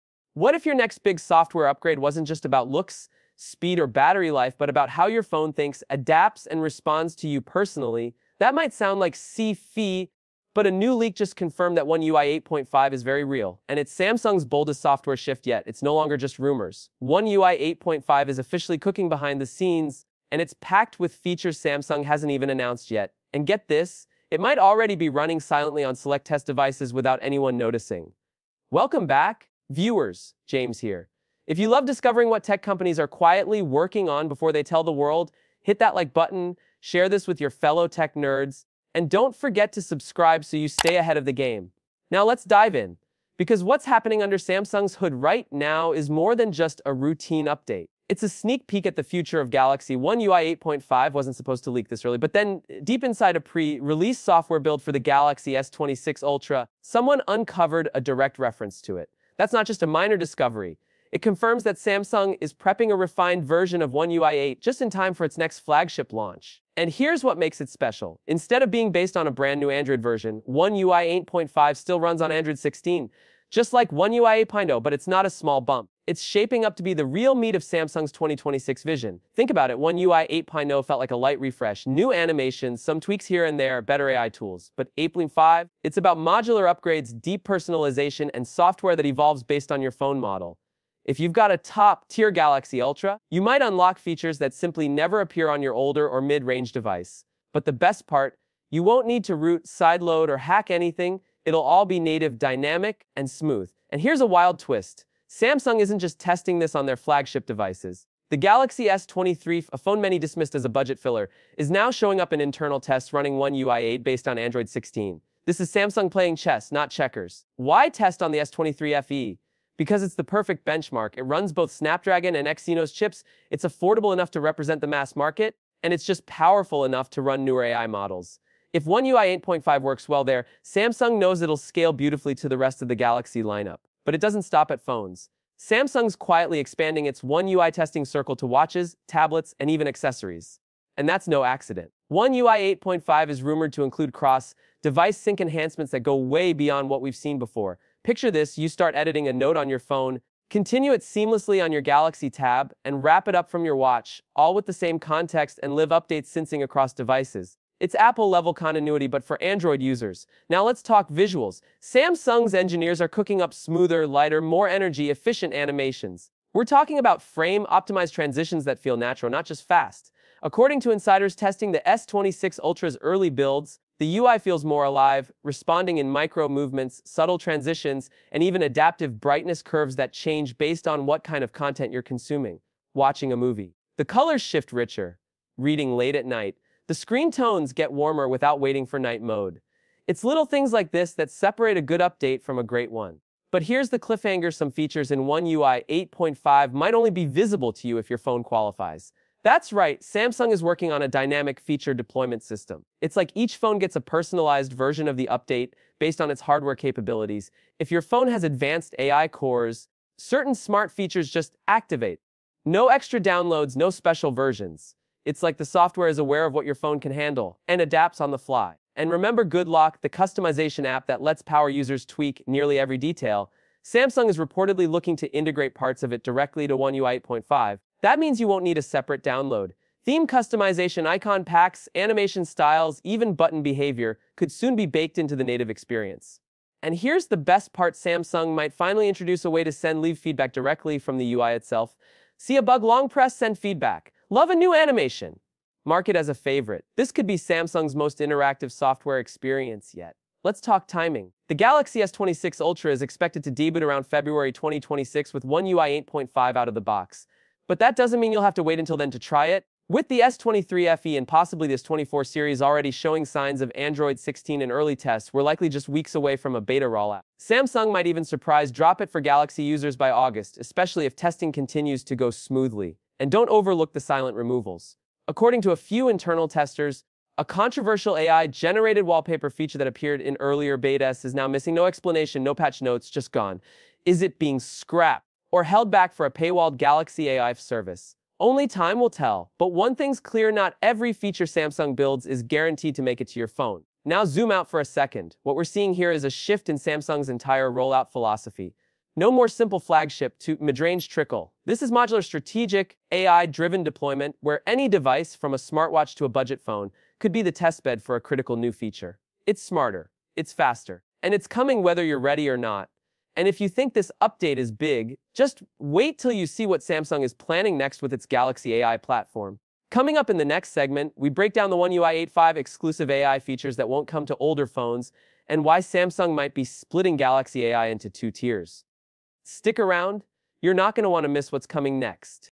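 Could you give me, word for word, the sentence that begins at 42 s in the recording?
Now let's dive in, because what's happening under Samsung's hood right now is more than just a routine update.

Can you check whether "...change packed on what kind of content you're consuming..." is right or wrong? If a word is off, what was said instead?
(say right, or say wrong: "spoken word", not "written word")
wrong: "based", not "packed".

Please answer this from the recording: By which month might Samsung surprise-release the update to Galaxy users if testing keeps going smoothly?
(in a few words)
August.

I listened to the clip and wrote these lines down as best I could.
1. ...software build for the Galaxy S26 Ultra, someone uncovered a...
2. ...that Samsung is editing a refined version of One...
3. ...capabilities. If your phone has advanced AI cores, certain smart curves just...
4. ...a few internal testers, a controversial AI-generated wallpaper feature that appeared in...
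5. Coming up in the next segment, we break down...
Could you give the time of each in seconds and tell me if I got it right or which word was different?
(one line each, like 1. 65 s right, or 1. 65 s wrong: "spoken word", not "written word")
1. 54 s right
2. 61 s wrong: "prepping", not "editing"
3. 206 s wrong: "features", not "curves"
4. 275 s right
5. 319 s right.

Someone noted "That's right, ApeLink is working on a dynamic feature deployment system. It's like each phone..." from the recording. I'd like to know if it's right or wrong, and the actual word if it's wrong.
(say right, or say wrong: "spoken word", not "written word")
wrong: "Samsung", not "ApeLink".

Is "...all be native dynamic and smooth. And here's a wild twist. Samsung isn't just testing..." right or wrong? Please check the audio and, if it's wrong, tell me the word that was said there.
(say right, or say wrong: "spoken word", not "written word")
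right.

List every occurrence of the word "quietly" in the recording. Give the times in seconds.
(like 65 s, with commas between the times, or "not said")
33 s, 136 s.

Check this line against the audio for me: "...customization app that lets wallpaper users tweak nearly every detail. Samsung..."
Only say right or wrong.
wrong.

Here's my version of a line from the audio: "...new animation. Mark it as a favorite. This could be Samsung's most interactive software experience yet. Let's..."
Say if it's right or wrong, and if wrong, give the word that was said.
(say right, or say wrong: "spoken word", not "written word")
right.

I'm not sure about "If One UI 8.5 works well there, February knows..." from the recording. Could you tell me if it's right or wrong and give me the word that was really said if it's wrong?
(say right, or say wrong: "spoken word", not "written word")
wrong: "Samsung", not "February".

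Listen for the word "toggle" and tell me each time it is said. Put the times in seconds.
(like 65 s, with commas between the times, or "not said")
not said.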